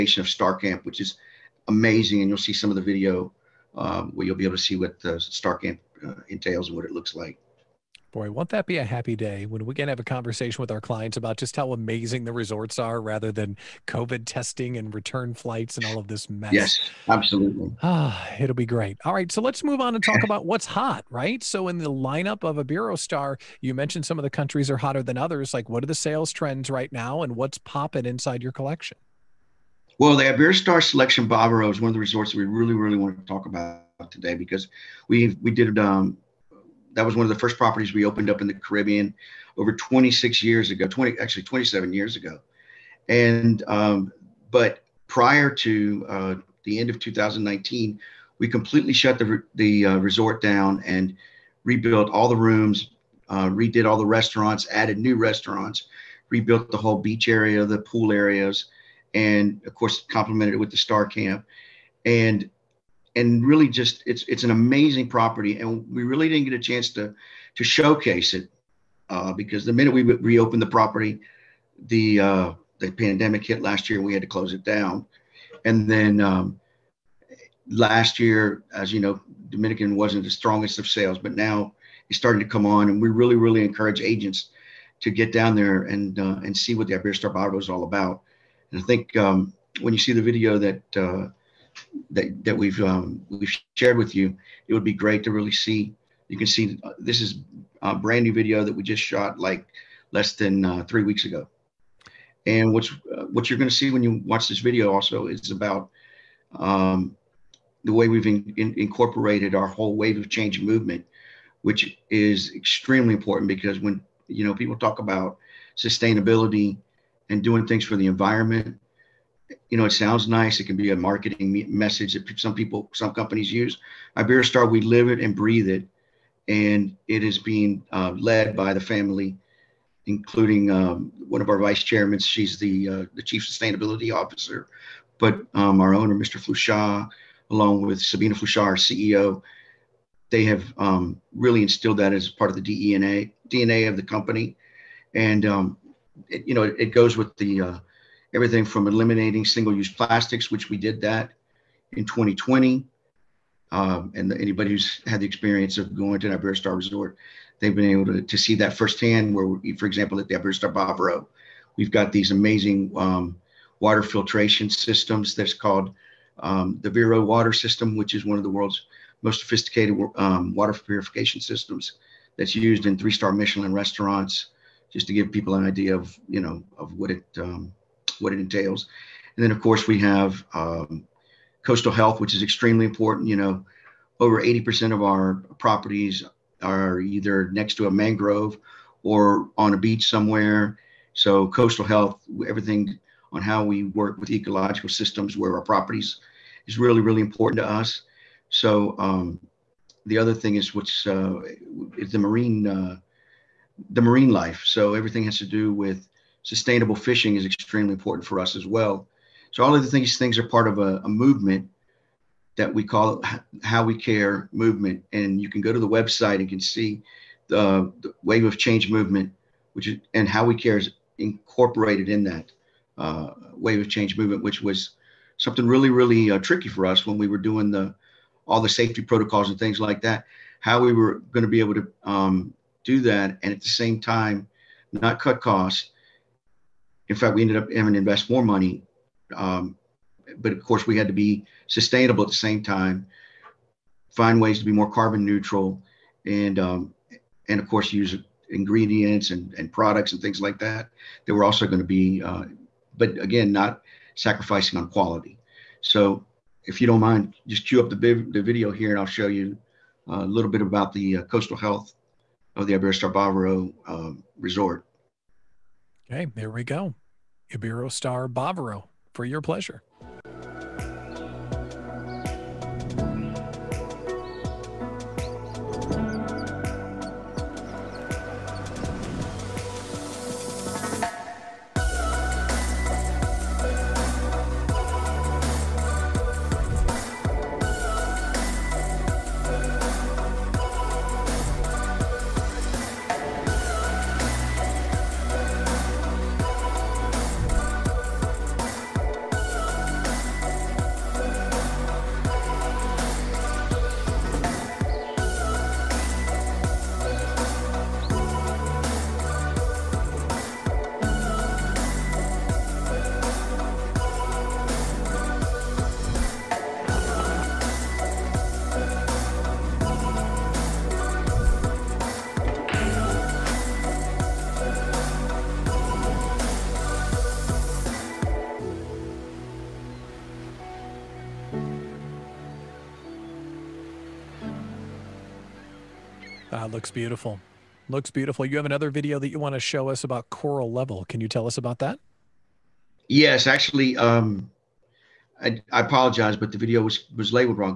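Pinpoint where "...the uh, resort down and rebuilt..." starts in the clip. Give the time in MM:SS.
00:49.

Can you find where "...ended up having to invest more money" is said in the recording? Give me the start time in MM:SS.
03:57.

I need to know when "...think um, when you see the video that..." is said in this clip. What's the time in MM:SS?
01:28.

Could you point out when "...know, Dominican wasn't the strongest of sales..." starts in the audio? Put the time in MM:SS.
01:18.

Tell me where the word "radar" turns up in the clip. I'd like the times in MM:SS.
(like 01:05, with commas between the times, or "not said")
not said.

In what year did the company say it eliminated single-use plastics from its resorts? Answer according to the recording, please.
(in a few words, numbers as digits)
2020.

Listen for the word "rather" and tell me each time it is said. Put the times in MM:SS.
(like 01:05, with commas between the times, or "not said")
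00:12.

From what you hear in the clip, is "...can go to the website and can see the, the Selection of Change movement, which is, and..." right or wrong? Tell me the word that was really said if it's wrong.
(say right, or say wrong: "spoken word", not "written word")
wrong: "Wave", not "Selection".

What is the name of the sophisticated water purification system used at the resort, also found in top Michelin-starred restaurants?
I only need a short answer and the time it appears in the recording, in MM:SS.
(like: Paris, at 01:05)
Vero water system, at 02:46.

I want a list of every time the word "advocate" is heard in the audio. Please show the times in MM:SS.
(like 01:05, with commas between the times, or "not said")
not said.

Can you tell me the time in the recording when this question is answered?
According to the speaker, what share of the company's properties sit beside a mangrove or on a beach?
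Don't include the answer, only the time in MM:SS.
03:04.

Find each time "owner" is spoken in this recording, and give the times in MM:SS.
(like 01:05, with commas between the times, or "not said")
02:15.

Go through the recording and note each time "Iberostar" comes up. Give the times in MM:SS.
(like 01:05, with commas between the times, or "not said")
00:22, 00:30, 01:26, 02:04, 04:22.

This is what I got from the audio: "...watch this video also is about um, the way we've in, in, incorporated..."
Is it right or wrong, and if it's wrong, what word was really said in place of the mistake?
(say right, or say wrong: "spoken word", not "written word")
right.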